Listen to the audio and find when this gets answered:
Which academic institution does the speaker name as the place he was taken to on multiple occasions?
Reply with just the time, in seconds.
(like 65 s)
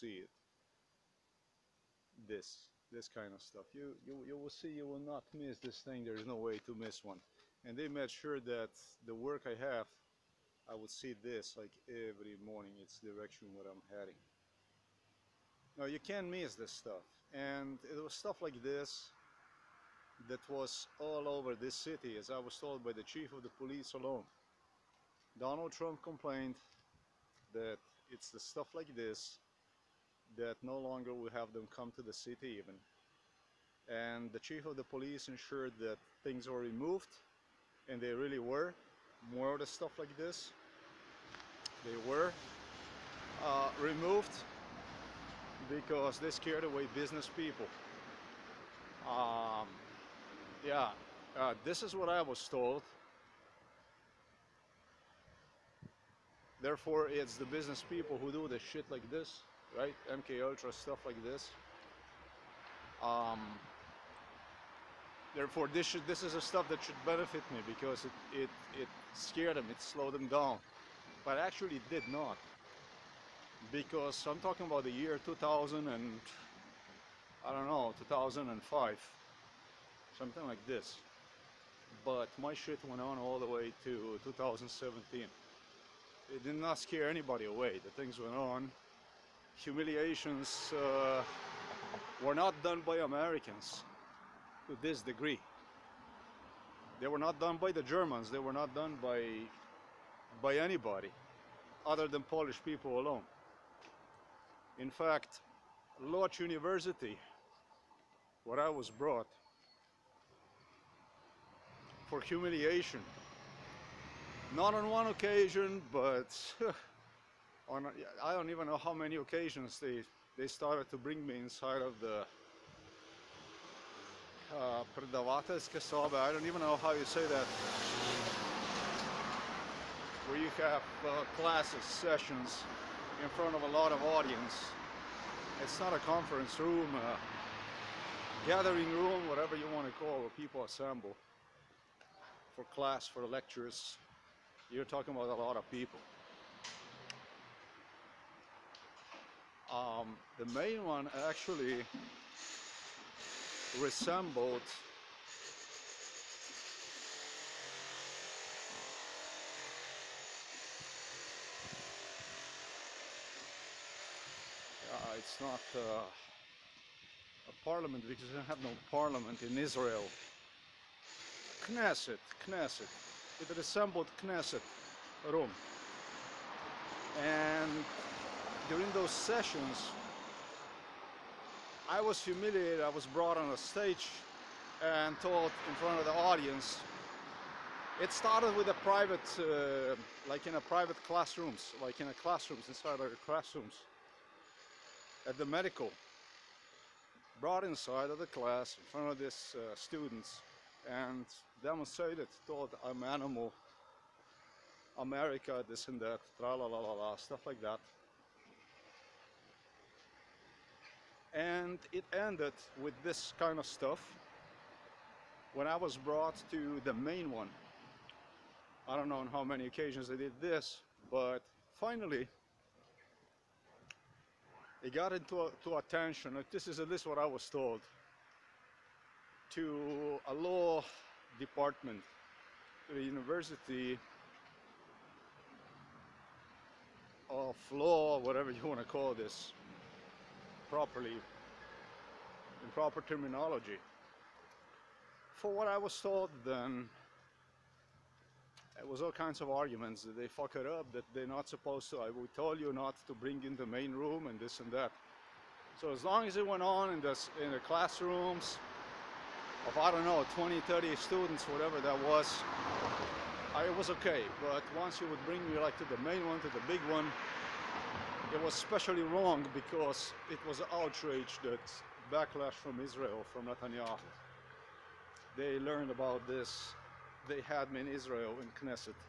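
106 s.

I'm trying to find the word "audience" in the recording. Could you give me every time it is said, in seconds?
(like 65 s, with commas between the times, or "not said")
134 s, 186 s.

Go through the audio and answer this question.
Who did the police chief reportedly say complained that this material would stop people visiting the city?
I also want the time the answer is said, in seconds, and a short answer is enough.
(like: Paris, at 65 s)
Donald Trump, at 25 s.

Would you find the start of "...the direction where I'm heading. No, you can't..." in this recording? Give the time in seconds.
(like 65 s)
13 s.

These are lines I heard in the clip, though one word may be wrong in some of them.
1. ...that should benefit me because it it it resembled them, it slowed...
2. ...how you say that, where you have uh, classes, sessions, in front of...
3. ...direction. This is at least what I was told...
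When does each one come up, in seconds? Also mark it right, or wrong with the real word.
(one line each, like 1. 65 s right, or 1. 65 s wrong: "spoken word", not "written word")
1. 66 s wrong: "scared", not "resembled"
2. 126 s right
3. 225 s wrong: "attention", not "direction".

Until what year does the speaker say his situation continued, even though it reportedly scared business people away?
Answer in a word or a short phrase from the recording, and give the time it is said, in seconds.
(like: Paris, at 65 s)
2017, at 84 s.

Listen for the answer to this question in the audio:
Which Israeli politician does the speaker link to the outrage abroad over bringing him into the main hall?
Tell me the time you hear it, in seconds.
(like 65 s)
273 s.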